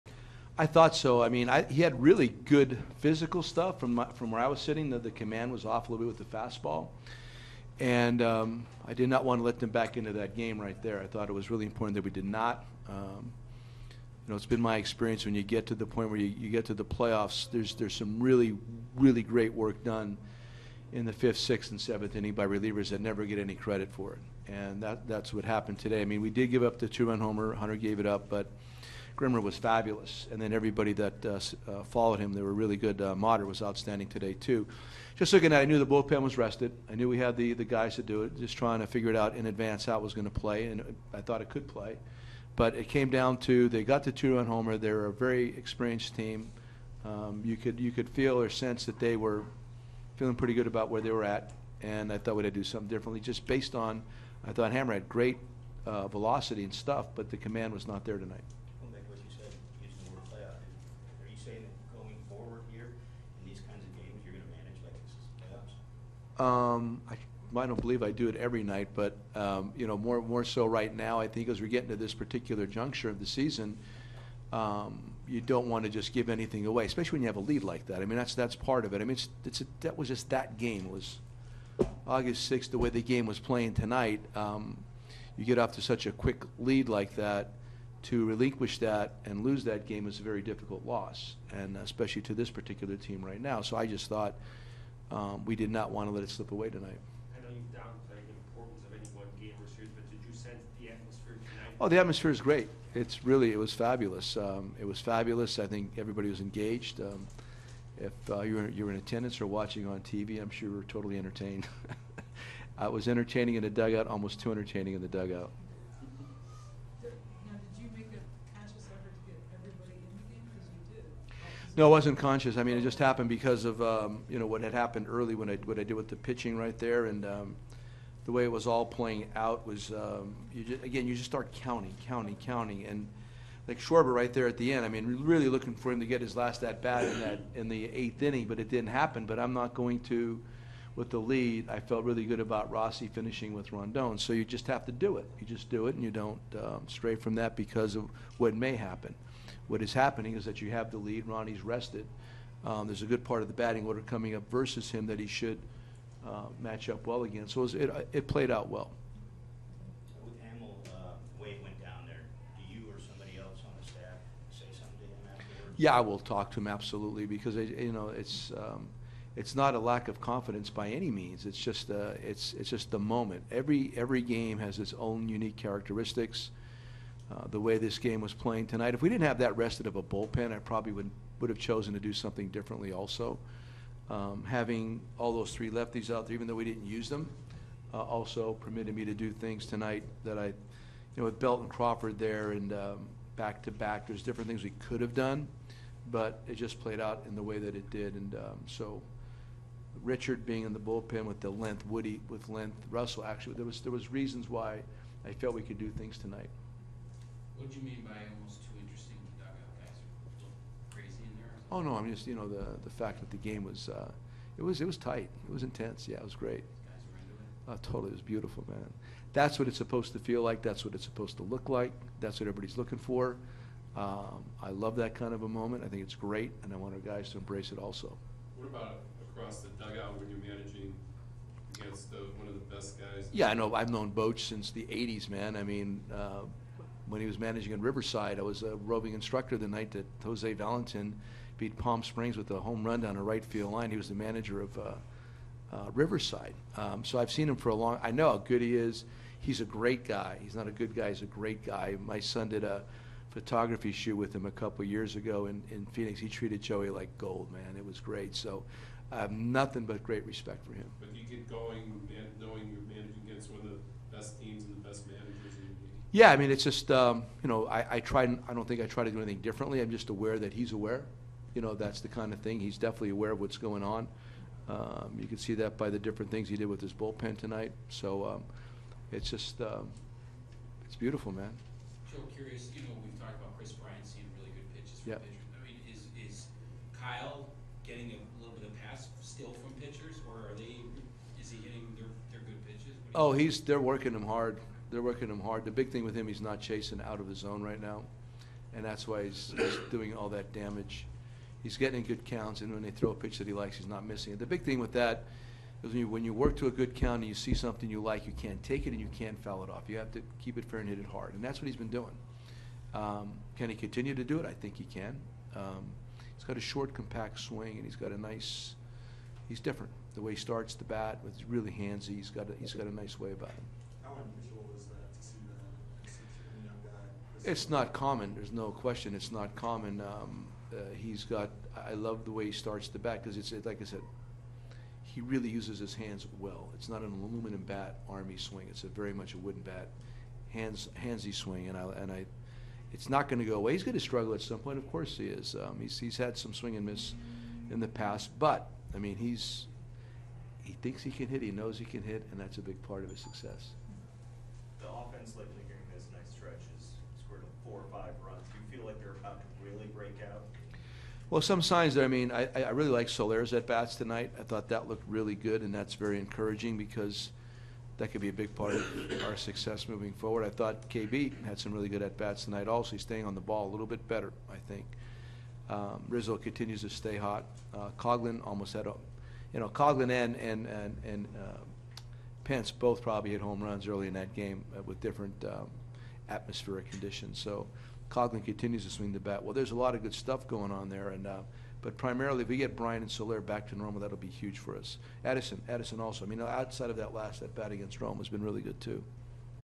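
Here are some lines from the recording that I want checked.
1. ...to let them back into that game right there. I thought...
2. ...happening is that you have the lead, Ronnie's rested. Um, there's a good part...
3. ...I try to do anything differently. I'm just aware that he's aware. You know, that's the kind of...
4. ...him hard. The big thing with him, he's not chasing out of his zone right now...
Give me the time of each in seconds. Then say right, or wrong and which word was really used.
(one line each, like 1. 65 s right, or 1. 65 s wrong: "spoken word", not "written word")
1. 9 s right
2. 149 s right
3. 268 s right
4. 295 s right.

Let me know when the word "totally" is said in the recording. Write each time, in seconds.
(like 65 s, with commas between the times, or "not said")
110 s, 217 s.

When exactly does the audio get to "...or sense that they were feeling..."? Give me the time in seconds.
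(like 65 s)
48 s.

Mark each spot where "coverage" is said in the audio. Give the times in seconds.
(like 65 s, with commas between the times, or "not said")
not said.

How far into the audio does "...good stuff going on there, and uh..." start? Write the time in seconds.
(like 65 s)
390 s.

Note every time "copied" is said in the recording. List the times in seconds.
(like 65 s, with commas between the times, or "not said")
not said.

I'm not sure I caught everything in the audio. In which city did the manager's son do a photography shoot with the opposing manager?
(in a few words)
Phoenix.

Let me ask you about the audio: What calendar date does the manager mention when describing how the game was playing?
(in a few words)
August 6.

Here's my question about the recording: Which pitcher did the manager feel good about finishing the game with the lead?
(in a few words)
Rondon.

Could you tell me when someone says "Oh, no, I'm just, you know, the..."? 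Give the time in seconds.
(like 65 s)
211 s.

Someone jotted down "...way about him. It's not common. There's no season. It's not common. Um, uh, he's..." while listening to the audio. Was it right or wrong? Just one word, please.
wrong.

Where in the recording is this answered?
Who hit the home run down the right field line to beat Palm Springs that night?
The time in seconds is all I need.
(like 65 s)
240 s.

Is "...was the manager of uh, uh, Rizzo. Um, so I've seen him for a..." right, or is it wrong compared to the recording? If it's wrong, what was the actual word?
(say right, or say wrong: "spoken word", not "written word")
wrong: "Riverside", not "Rizzo".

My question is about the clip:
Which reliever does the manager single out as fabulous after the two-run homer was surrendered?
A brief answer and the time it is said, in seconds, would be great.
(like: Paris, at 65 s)
Grimmer, at 29 s.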